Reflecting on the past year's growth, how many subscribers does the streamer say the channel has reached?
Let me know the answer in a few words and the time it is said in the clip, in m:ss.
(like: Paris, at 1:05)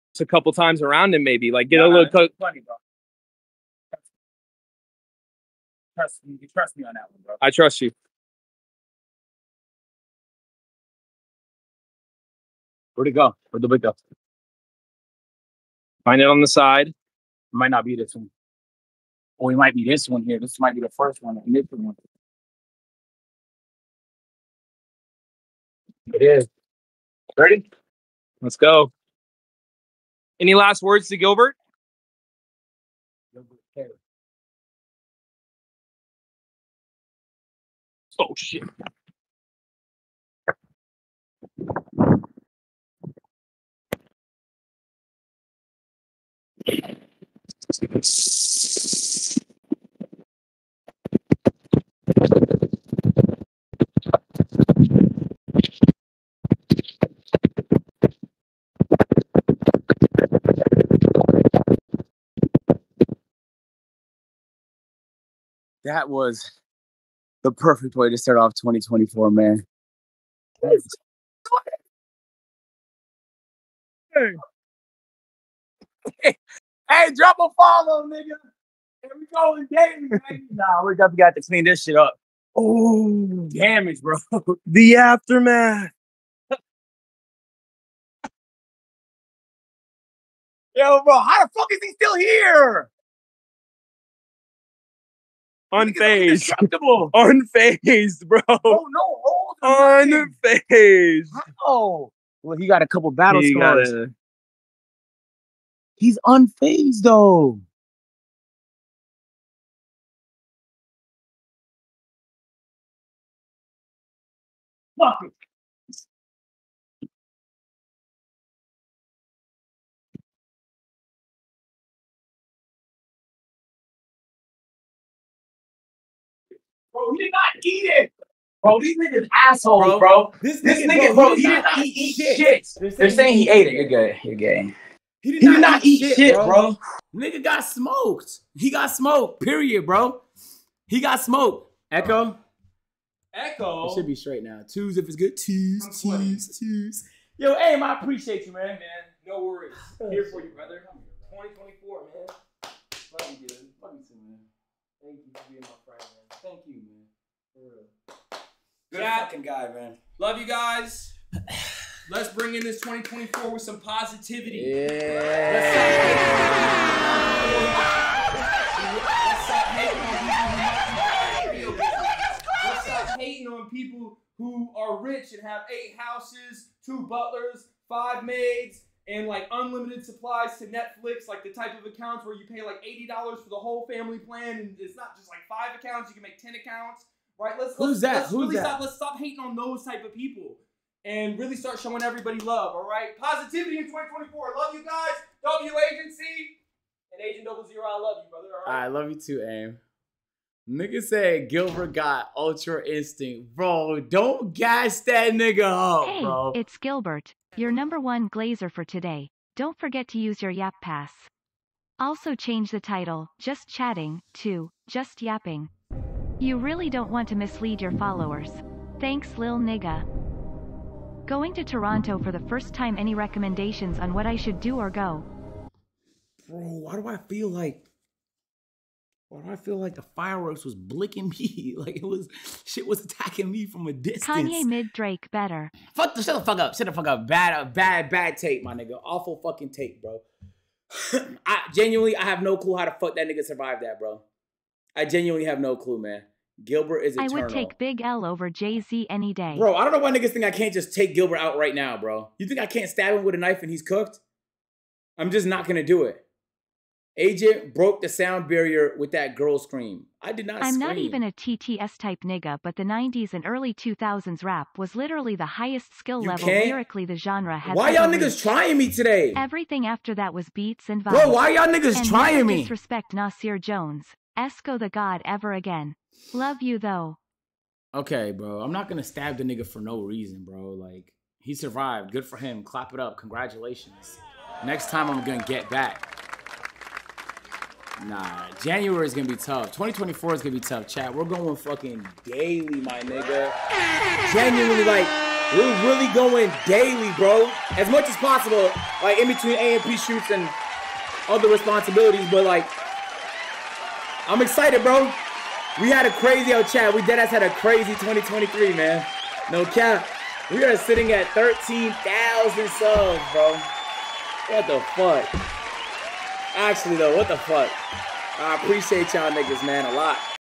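13,000, at 5:11.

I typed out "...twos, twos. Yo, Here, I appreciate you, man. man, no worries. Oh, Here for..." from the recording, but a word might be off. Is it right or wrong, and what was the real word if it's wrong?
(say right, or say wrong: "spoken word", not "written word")
wrong: "Aim", not "Here".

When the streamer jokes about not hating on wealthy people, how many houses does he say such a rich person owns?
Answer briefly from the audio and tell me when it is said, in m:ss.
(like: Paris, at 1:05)
8, at 2:55.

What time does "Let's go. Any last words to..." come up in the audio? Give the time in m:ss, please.
0:28.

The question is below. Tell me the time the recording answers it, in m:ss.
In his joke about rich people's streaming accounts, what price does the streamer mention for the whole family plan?
3:02.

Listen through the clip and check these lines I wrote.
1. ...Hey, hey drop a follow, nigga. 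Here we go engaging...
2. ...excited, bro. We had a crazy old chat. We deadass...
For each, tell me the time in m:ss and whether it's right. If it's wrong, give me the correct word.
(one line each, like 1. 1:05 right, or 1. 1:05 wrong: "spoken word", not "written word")
1. 1:16 right
2. 5:04 right.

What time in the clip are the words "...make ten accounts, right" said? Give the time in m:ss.
3:06.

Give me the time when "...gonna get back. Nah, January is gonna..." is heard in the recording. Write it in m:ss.
4:45.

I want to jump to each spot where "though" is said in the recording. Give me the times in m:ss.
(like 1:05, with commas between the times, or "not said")
1:47, 4:36, 5:16.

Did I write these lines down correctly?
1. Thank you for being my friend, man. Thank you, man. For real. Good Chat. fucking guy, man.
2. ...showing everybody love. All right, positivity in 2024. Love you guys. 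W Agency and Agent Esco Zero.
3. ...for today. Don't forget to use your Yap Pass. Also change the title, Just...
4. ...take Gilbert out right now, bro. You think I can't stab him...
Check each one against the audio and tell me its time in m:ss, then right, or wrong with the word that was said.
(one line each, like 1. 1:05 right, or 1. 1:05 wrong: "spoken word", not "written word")
1. 2:35 right
2. 3:11 wrong: "Double", not "Esco"
3. 3:28 right
4. 4:10 right.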